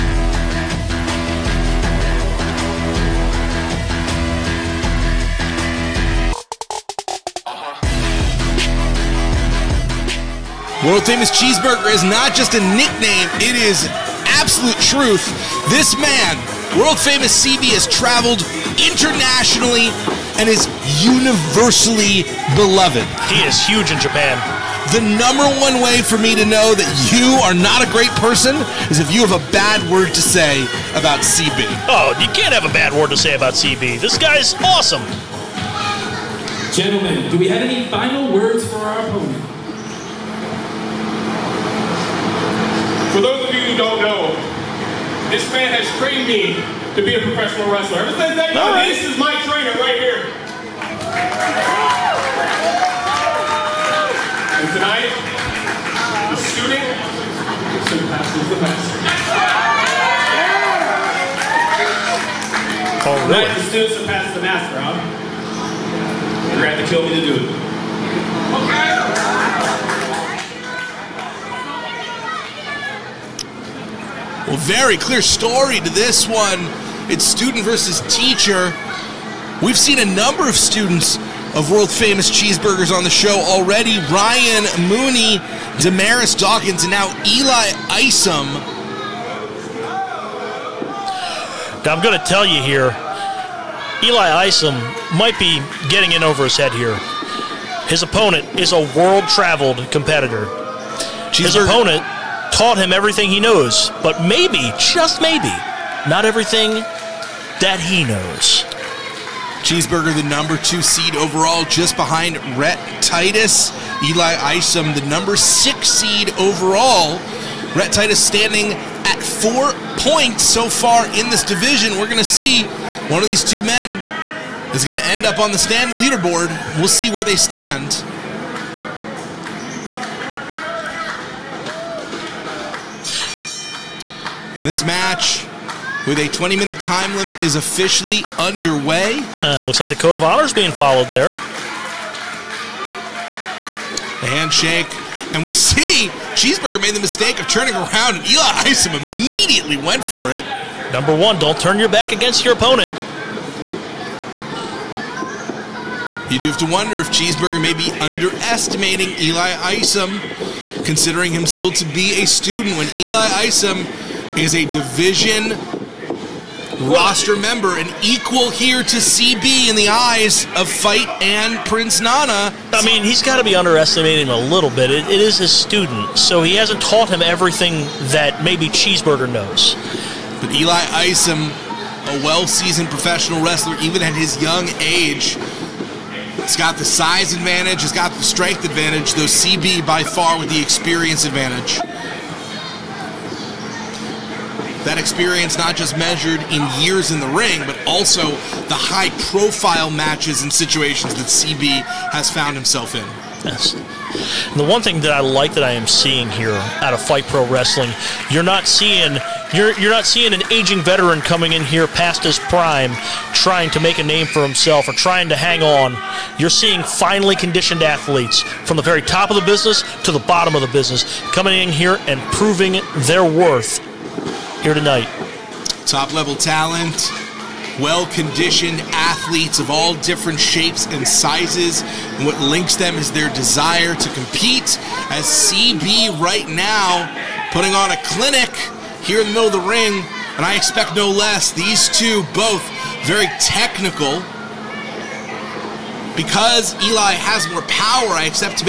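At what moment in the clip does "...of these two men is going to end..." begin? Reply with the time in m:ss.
2:03.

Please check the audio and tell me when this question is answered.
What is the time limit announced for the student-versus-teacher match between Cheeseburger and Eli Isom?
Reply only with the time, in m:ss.
2:16.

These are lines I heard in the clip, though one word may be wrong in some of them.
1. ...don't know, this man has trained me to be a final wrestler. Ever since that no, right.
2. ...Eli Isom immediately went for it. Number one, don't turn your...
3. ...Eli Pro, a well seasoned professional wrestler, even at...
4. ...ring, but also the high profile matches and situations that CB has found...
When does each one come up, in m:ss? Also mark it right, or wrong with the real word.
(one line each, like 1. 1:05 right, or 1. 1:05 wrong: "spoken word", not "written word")
1. 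0:43 wrong: "professional", not "final"
2. 2:28 right
3. 3:00 wrong: "Isom", not "Pro"
4. 3:17 right.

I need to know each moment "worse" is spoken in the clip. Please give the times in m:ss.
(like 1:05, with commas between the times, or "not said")
not said.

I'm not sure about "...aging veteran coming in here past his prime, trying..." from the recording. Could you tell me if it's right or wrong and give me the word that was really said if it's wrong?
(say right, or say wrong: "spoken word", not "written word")
right.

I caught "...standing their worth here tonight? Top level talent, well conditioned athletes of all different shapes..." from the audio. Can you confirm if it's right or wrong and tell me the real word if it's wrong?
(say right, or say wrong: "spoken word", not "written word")
wrong: "proving", not "standing".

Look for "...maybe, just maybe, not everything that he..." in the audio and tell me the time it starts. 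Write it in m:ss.
1:44.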